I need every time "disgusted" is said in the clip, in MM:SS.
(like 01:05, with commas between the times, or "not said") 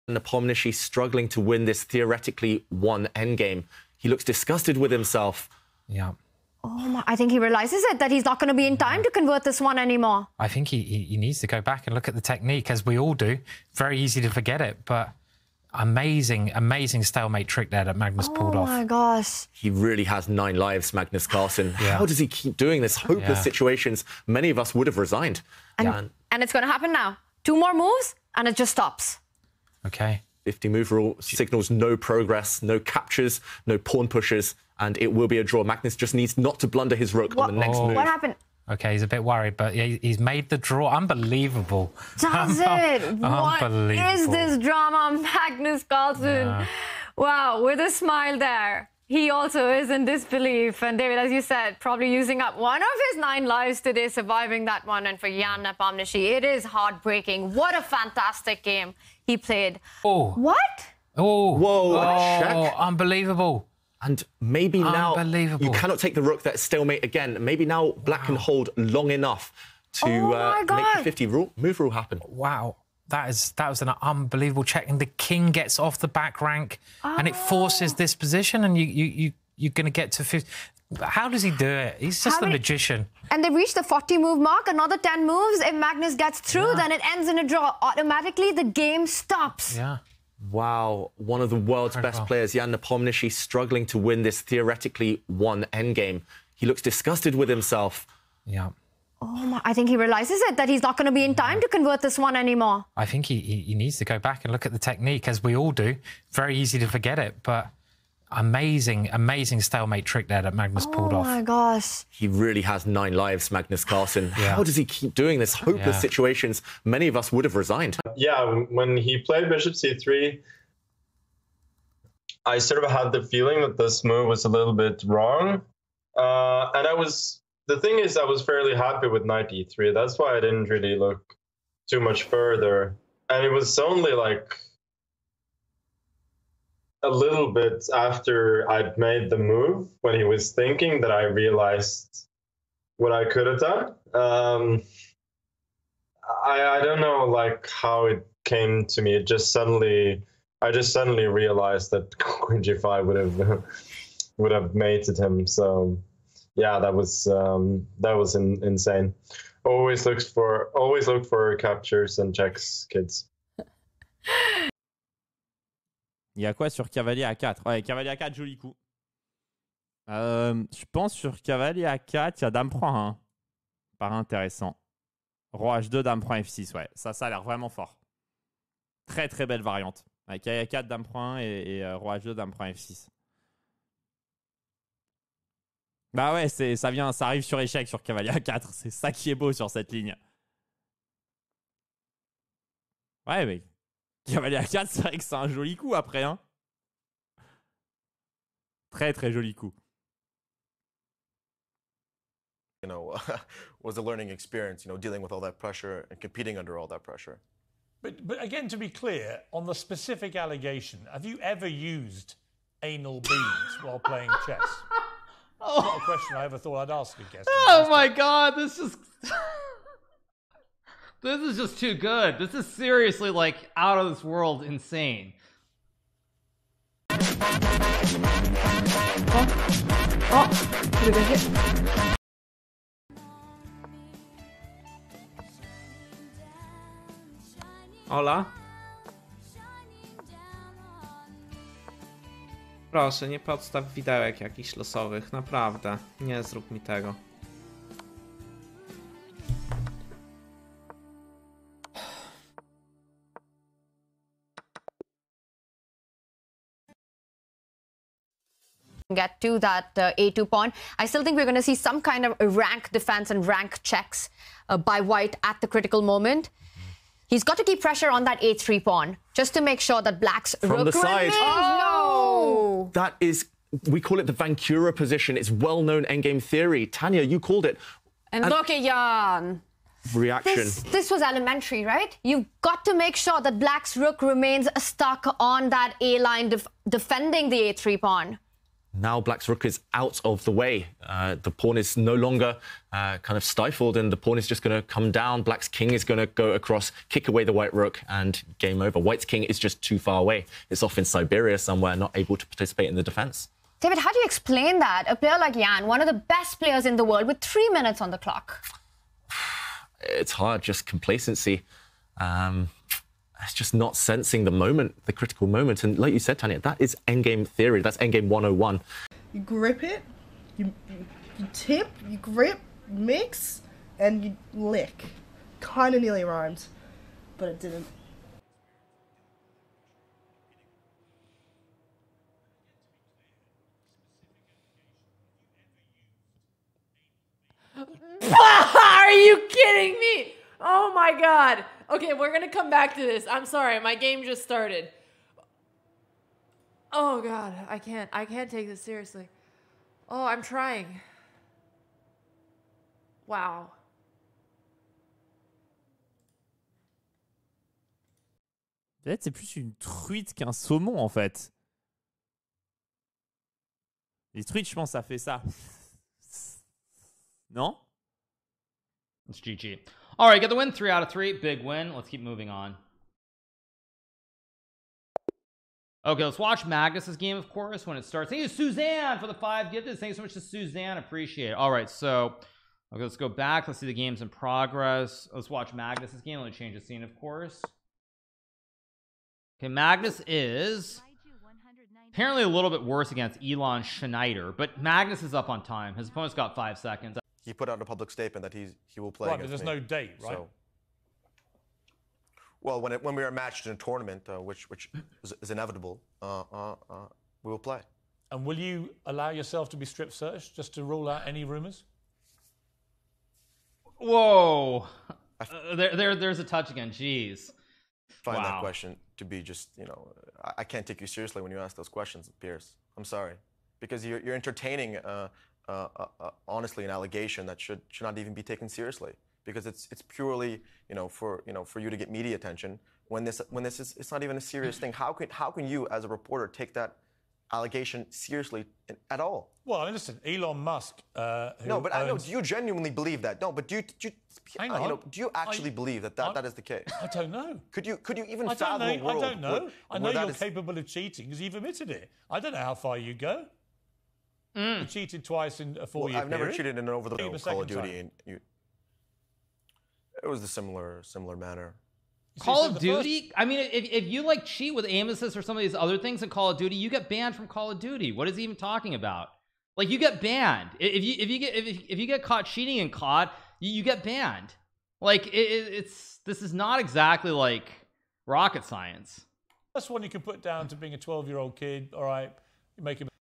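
00:04, 01:36.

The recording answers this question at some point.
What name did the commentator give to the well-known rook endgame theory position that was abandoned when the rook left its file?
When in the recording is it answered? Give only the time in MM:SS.
04:34.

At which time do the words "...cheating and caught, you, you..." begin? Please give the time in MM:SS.
07:52.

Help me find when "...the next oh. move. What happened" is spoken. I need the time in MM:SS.
00:37.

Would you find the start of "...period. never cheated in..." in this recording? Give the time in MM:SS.
07:36.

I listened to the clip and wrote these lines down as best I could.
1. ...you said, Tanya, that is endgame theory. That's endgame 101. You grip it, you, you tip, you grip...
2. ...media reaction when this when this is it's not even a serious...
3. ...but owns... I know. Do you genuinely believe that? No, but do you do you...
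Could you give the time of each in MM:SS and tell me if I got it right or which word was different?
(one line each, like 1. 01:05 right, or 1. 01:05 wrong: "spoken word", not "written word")
1. 05:16 right
2. 07:12 wrong: "attention", not "reaction"
3. 07:21 right.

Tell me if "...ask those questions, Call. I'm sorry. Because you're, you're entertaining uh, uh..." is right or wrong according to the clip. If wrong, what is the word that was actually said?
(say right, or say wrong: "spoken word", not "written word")
wrong: "Piers", not "Call".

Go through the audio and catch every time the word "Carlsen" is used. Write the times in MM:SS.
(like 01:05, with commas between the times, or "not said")
00:21, 00:45, 01:53.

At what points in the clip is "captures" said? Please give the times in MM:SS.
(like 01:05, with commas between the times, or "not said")
00:32, 02:41.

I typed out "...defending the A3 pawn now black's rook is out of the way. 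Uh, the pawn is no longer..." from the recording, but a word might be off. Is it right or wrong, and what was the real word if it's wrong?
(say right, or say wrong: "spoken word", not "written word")
right.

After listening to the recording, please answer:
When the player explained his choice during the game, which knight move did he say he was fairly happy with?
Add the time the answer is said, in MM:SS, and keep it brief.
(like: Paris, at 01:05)
knight e3, at 02:09.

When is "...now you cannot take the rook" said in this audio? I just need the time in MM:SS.
01:04.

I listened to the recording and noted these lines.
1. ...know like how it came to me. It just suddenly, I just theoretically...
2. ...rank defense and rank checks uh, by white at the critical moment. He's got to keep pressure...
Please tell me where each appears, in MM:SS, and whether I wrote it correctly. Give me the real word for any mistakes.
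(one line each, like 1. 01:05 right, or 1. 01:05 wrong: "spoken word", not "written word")
1. 02:27 wrong: "suddenly", not "theoretically"
2. 04:22 right.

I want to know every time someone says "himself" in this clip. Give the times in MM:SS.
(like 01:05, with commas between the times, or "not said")
00:04, 01:37.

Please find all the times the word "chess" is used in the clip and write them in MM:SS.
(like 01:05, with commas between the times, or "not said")
03:34.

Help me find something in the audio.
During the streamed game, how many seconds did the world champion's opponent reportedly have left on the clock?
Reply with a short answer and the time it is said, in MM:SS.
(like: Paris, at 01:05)
5, at 06:36.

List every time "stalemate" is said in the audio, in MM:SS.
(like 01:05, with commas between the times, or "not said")
00:17, 01:06, 01:49.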